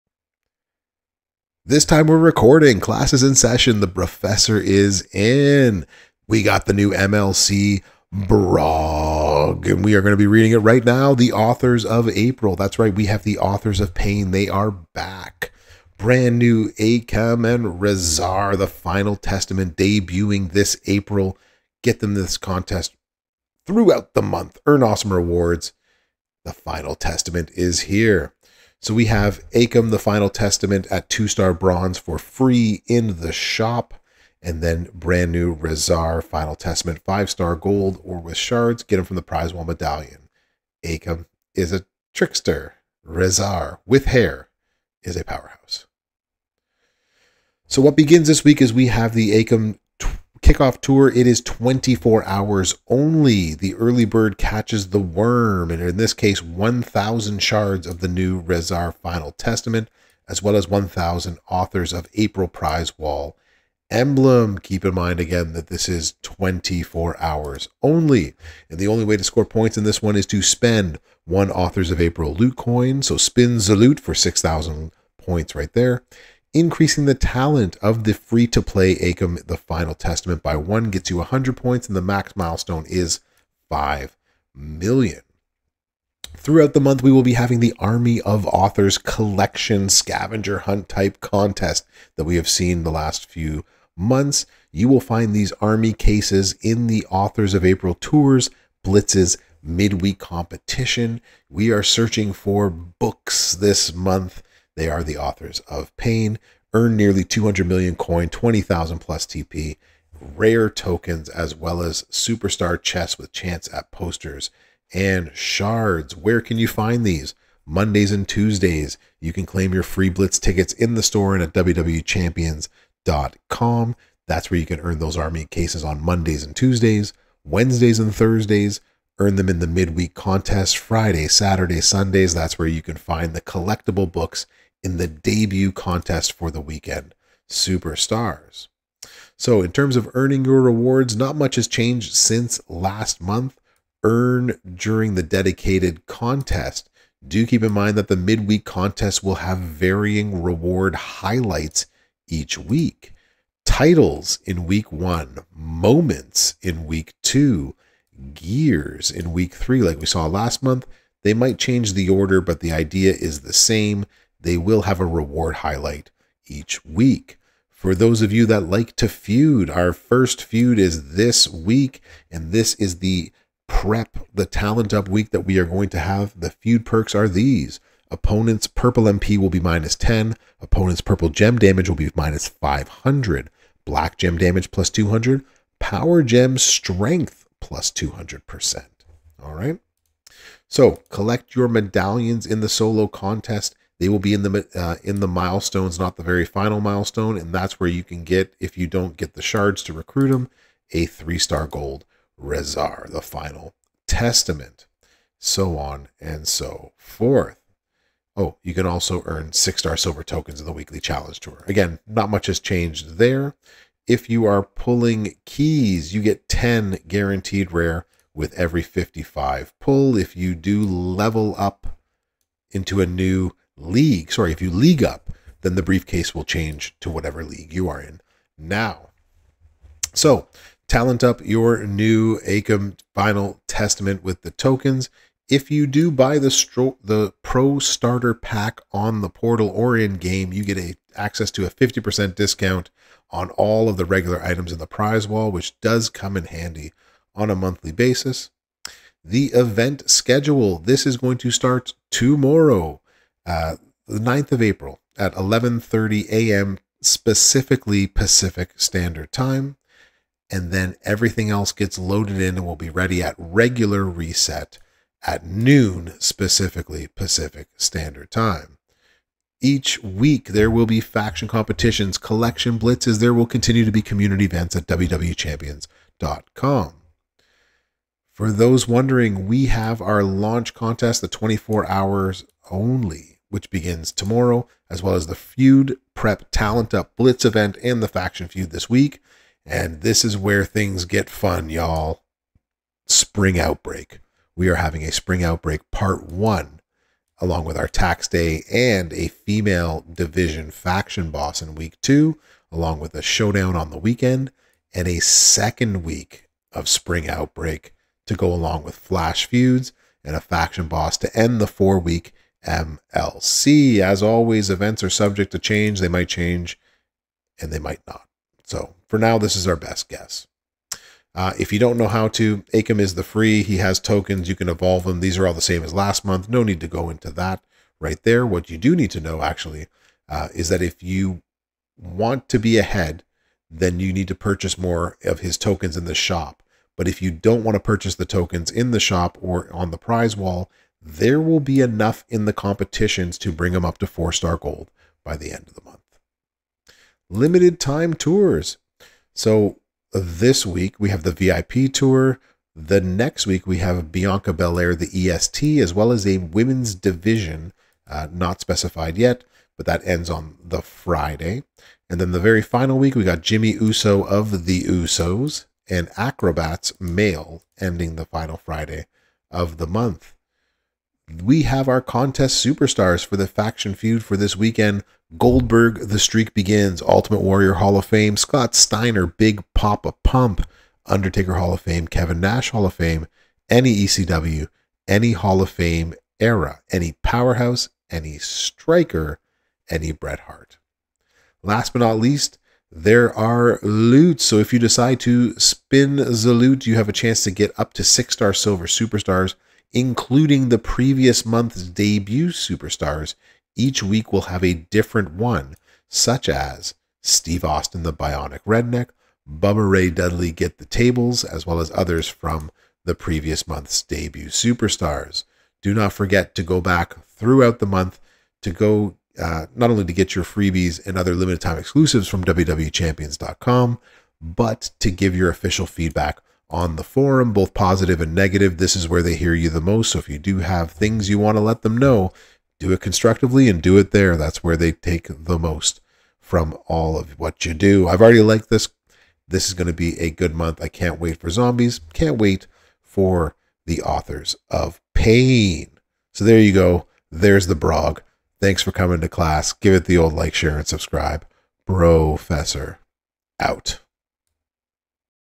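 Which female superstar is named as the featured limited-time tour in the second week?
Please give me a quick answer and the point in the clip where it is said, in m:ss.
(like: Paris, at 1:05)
Bianca Belair, at 5:54.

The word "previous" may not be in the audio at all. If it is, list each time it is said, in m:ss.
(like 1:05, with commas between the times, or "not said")
6:40, 6:53.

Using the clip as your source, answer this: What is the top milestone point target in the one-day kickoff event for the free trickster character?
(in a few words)
5 million.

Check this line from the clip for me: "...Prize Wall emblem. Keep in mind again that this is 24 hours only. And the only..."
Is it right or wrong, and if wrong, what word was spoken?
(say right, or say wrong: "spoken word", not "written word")
right.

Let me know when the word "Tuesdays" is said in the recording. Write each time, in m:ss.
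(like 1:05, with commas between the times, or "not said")
1:58, 2:06.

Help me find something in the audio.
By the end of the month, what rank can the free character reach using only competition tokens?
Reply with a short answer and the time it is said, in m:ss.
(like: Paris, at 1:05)
four star gold, at 5:44.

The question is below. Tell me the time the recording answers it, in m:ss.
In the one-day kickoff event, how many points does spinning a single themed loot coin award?
1:14.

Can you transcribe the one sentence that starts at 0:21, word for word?
Get them this contest throughout the month.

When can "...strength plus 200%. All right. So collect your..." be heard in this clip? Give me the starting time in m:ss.
3:06.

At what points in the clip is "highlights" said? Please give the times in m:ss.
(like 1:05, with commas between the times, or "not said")
2:30, 2:45.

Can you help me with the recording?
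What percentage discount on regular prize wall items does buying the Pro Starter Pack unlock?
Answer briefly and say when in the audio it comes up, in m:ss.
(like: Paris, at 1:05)
50%, at 4:01.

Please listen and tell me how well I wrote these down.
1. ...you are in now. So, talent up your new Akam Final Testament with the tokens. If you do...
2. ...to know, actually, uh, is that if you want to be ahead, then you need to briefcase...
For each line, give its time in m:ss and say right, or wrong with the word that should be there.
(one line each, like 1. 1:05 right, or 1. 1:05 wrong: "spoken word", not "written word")
1. 3:47 right
2. 5:29 wrong: "purchase", not "briefcase".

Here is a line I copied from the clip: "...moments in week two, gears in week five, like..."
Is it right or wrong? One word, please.
wrong.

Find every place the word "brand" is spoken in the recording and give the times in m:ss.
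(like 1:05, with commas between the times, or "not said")
0:15, 0:34.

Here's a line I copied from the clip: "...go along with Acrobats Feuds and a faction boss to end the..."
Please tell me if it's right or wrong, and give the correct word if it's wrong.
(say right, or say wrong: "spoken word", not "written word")
wrong: "Flash", not "Acrobats".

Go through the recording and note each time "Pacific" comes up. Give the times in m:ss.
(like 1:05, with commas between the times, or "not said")
4:18, 4:27.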